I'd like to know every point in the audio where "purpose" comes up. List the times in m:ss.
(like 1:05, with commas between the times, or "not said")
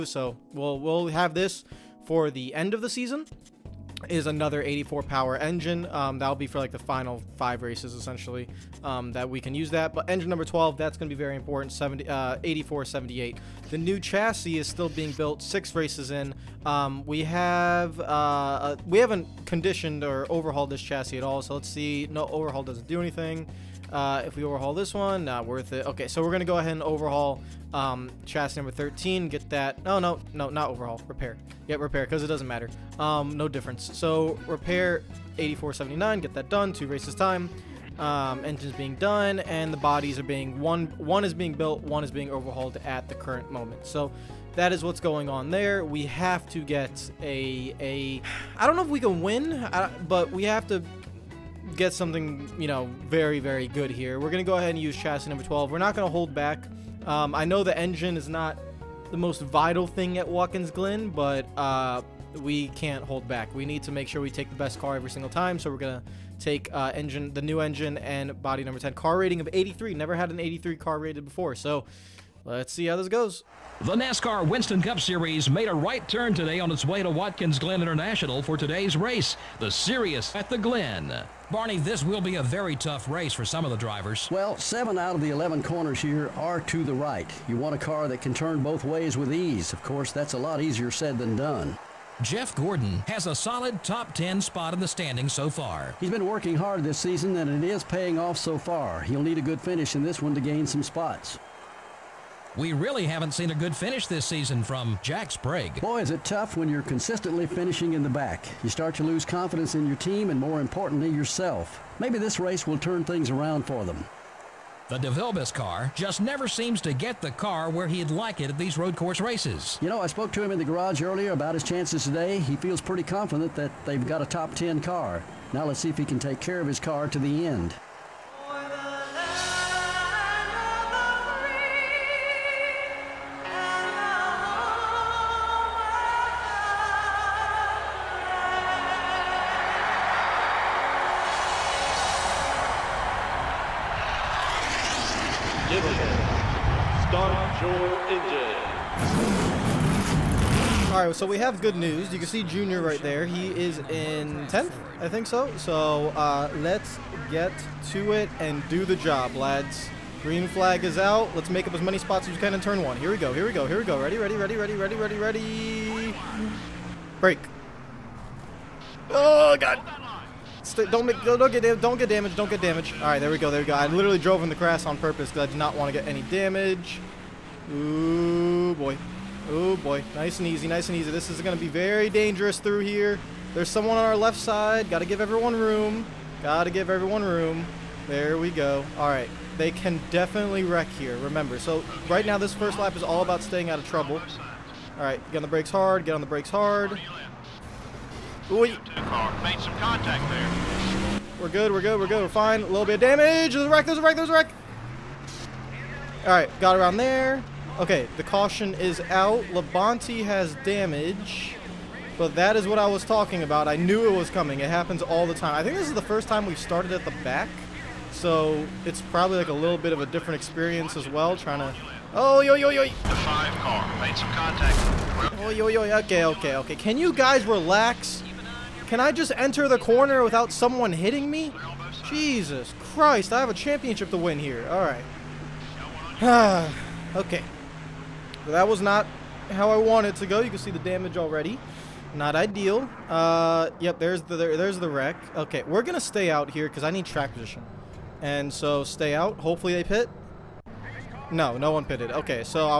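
2:54.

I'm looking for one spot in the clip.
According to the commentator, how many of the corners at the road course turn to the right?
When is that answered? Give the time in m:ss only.
1:24.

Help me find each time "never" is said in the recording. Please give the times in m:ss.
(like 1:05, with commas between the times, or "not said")
1:09, 1:56.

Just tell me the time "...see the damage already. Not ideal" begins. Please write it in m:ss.
4:00.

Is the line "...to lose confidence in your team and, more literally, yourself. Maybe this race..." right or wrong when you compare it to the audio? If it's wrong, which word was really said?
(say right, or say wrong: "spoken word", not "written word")
wrong: "importantly", not "literally".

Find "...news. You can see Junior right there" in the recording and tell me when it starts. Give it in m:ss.
2:31.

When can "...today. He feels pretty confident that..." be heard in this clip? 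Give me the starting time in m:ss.
2:02.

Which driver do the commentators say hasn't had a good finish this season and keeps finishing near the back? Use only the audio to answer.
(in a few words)
Jack Sprague.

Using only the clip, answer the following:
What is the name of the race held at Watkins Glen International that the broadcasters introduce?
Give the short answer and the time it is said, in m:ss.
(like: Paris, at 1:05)
the Sirius at the Glen, at 1:19.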